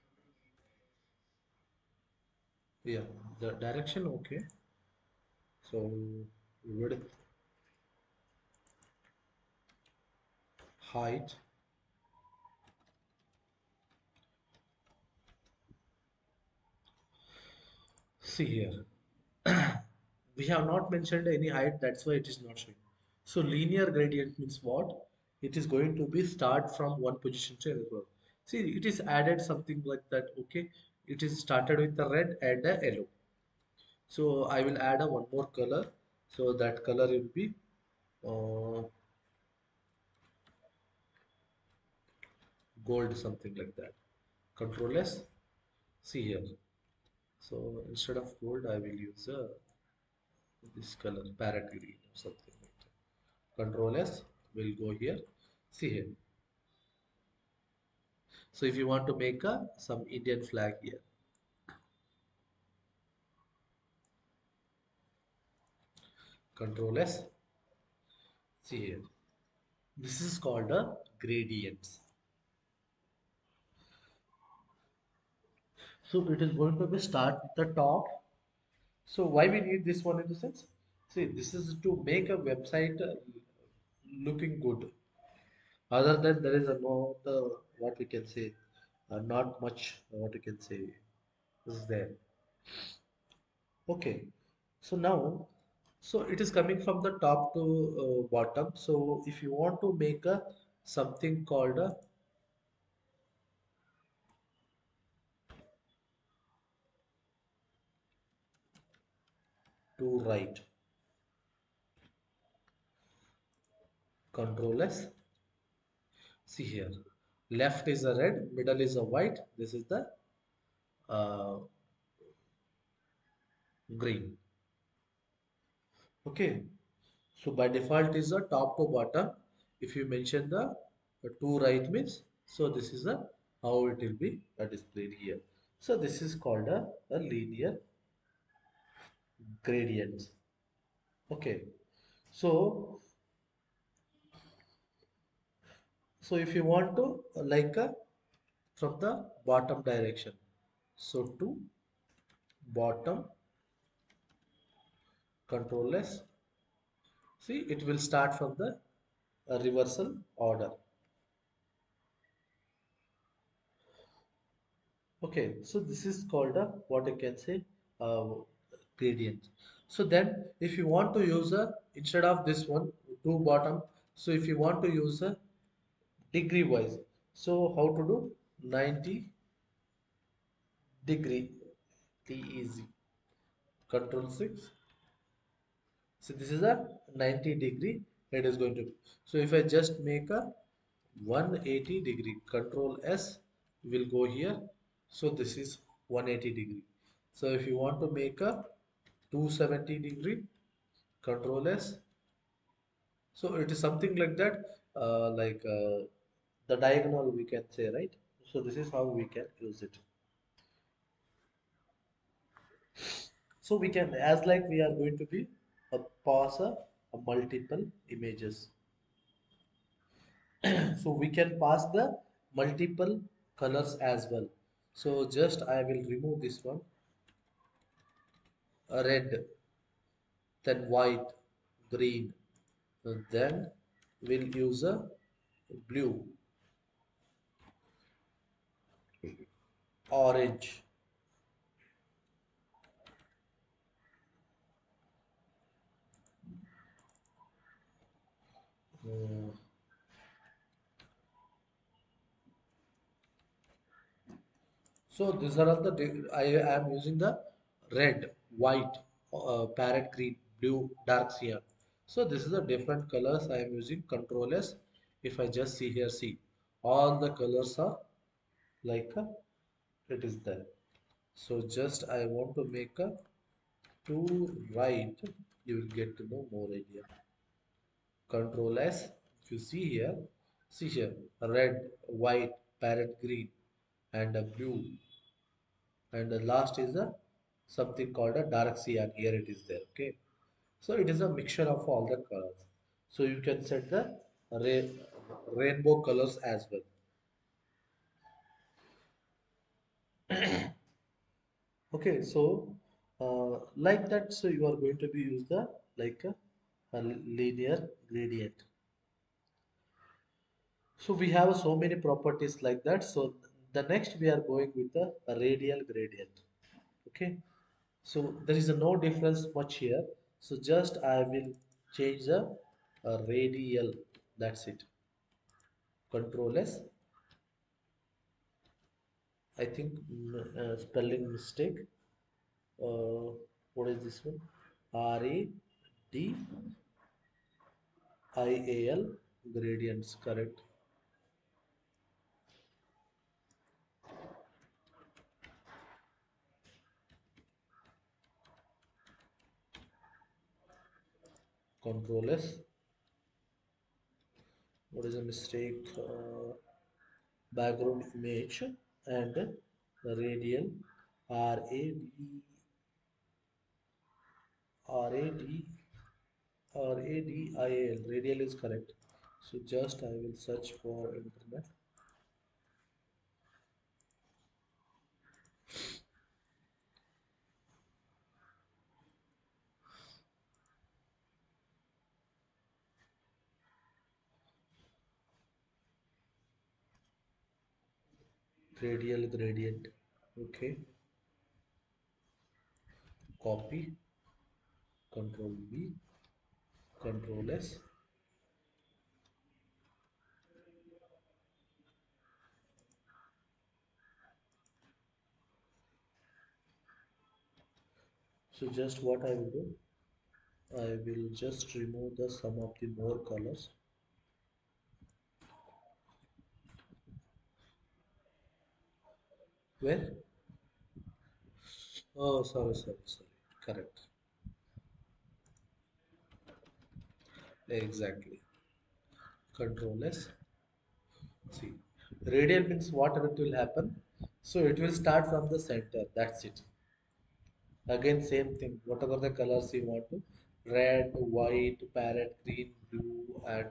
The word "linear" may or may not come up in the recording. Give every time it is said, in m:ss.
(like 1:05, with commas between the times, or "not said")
0:23, 2:17, 5:07.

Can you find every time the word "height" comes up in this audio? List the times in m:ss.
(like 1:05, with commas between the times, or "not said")
0:10, 0:21.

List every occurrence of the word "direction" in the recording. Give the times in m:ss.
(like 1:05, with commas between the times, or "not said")
0:03, 2:29.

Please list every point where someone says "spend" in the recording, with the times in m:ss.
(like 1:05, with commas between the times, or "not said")
not said.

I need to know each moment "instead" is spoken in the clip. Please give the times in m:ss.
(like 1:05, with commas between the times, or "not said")
0:47, 2:52.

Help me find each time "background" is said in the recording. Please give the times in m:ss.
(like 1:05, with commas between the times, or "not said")
5:57.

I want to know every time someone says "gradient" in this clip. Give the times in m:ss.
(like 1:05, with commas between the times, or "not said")
0:23, 1:11, 2:19, 2:49, 5:08, 5:15, 5:39, 6:29.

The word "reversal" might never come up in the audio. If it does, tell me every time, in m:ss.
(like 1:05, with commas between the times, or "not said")
2:39.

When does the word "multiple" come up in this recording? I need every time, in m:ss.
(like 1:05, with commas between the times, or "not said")
3:37, 3:42.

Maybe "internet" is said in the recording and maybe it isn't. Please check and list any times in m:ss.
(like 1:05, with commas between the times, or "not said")
6:11.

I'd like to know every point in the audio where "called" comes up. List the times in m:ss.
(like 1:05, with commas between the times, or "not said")
1:10, 1:41, 2:16, 2:46, 4:48.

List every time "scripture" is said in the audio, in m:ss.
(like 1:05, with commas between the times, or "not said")
not said.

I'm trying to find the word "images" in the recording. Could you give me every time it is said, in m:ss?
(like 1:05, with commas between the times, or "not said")
3:38, 5:58.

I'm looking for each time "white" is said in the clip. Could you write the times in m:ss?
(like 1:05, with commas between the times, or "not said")
1:59, 3:50, 4:18, 4:42, 7:21.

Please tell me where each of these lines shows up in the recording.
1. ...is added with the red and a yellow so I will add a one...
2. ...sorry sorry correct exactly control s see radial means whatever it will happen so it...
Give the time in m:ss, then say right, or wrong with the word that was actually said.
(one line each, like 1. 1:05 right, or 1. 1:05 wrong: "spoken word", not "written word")
1. 0:31 wrong: "started", not "added"
2. 7:02 right.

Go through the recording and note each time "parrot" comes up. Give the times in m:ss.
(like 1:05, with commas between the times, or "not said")
0:51, 4:19, 4:42, 7:21.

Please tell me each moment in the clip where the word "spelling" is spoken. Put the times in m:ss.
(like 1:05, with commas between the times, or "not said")
5:30.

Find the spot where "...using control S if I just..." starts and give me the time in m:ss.
4:23.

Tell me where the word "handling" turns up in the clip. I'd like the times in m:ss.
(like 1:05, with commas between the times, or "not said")
not said.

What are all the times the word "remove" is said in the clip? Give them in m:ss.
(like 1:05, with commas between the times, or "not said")
3:46, 6:51.